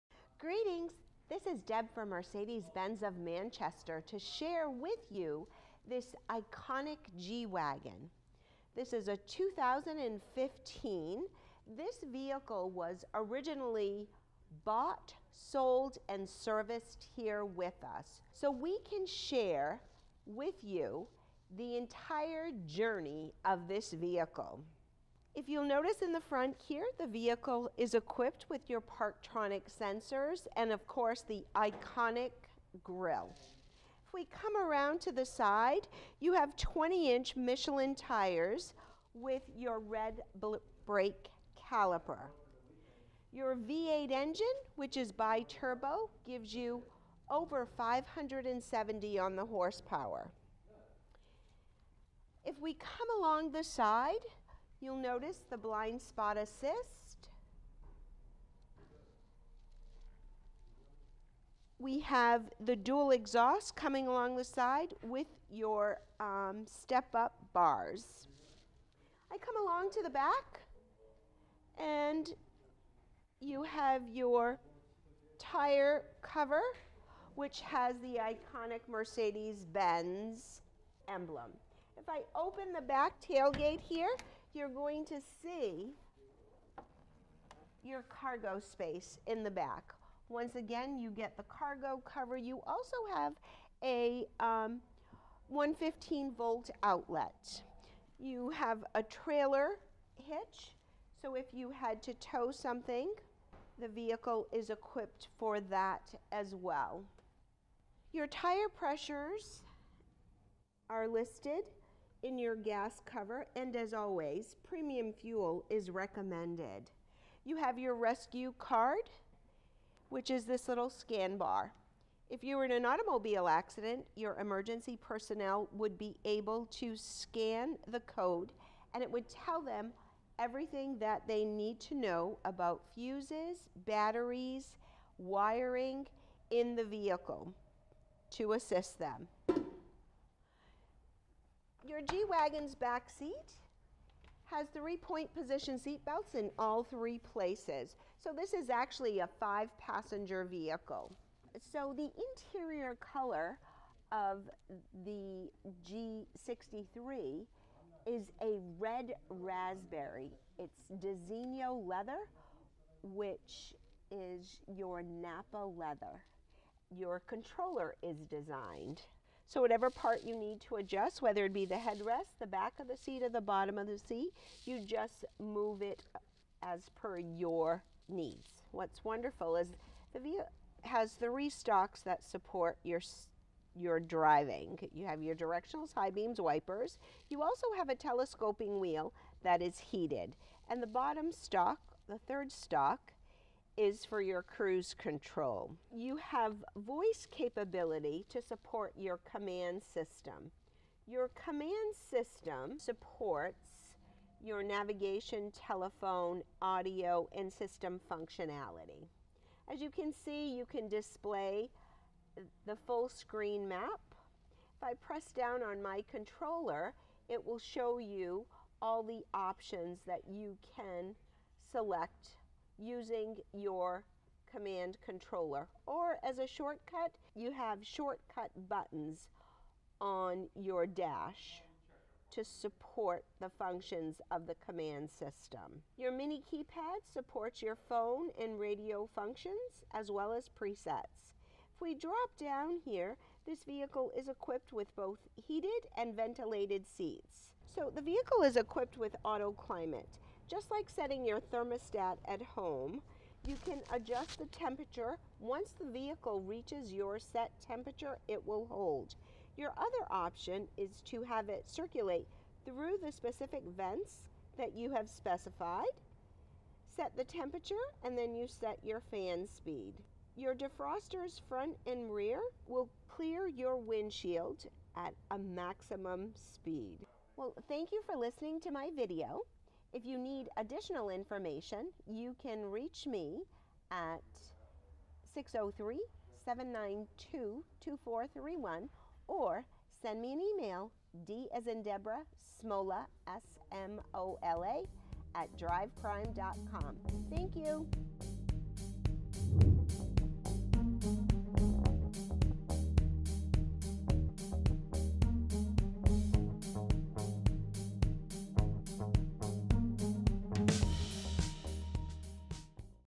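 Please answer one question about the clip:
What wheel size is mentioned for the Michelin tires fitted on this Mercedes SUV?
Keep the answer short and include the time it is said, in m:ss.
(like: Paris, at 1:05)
20 inch, at 0:36.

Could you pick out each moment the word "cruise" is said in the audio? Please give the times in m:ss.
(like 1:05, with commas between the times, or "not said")
3:14.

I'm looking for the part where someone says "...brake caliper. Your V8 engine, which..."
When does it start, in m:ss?
0:40.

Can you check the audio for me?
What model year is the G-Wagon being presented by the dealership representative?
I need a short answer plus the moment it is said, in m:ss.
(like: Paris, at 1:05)
2015, at 0:09.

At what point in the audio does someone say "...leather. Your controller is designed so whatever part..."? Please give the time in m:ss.
2:45.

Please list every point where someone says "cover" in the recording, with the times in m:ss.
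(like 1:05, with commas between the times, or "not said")
1:16, 1:32, 1:53.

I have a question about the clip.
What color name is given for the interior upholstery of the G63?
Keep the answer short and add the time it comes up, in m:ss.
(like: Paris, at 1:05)
red raspberry, at 2:38.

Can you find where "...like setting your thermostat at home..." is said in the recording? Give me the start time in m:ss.
4:10.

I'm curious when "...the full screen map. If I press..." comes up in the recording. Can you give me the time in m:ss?
3:32.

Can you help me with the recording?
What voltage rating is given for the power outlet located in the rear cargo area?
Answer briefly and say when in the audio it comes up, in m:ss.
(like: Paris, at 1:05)
115 volt, at 1:35.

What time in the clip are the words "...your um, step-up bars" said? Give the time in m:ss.
1:05.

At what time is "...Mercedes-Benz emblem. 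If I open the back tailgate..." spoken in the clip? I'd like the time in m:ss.
1:18.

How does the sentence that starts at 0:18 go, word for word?
So we can share with you the entire journey of this vehicle.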